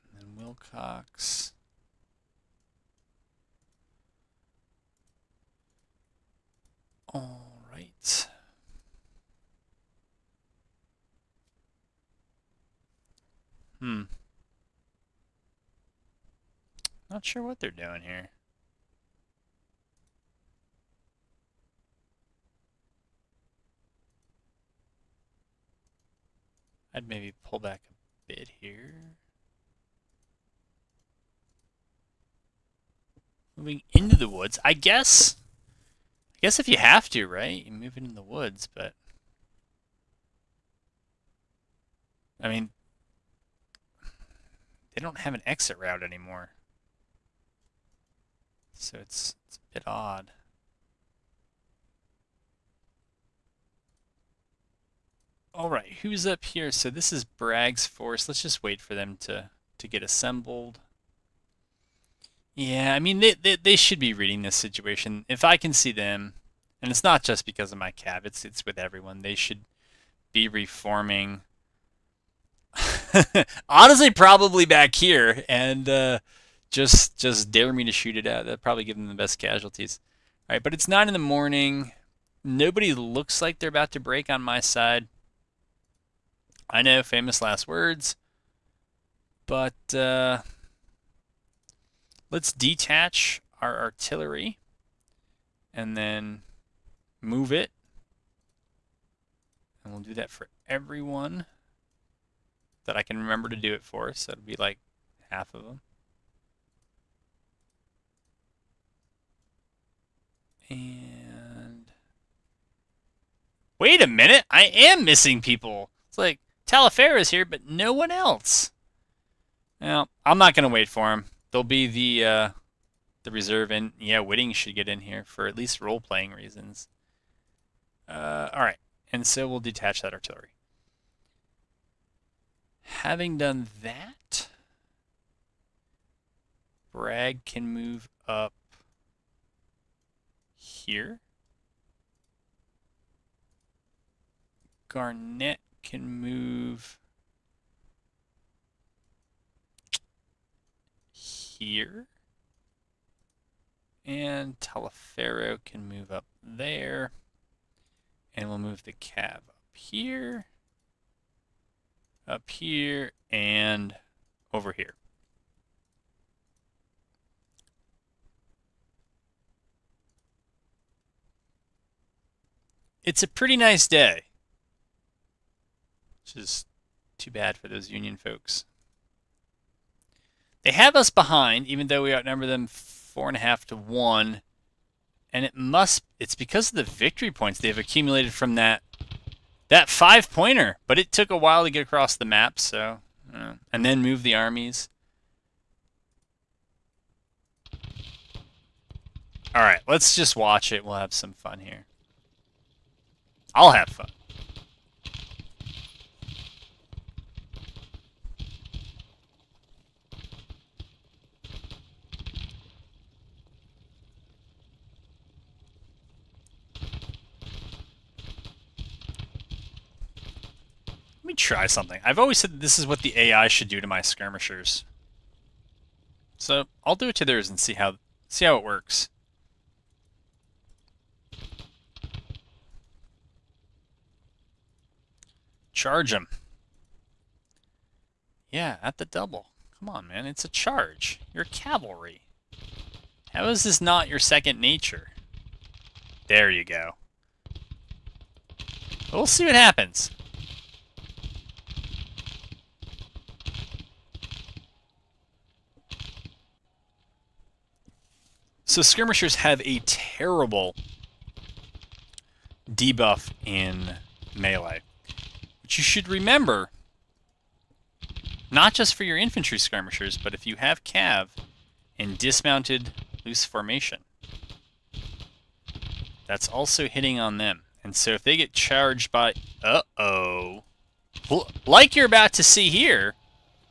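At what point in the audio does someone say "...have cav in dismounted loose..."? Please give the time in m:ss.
4:30.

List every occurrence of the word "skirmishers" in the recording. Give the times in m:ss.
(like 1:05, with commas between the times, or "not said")
3:44, 4:18, 4:29.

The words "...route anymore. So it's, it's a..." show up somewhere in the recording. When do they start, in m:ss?
0:45.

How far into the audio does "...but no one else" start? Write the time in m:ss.
1:57.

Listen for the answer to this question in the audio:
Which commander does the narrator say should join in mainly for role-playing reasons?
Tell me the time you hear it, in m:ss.
2:04.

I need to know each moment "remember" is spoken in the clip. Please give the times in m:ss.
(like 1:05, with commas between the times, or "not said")
1:43, 4:26.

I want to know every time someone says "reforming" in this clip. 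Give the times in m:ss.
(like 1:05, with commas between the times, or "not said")
1:10.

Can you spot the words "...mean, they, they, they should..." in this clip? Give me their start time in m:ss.
1:03.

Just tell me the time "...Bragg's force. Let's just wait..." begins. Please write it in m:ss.
0:57.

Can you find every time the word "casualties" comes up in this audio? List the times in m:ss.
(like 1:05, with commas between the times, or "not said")
1:19.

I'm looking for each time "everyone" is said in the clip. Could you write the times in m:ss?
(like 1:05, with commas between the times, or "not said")
1:08, 1:40.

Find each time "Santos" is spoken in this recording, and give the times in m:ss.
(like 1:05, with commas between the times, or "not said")
not said.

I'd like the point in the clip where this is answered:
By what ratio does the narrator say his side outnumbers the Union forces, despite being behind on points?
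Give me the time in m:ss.
3:02.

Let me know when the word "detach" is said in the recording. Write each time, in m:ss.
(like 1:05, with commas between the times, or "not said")
1:32, 2:09.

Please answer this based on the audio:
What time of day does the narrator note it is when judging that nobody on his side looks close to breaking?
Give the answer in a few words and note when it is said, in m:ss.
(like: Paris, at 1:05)
9 in the morning, at 1:20.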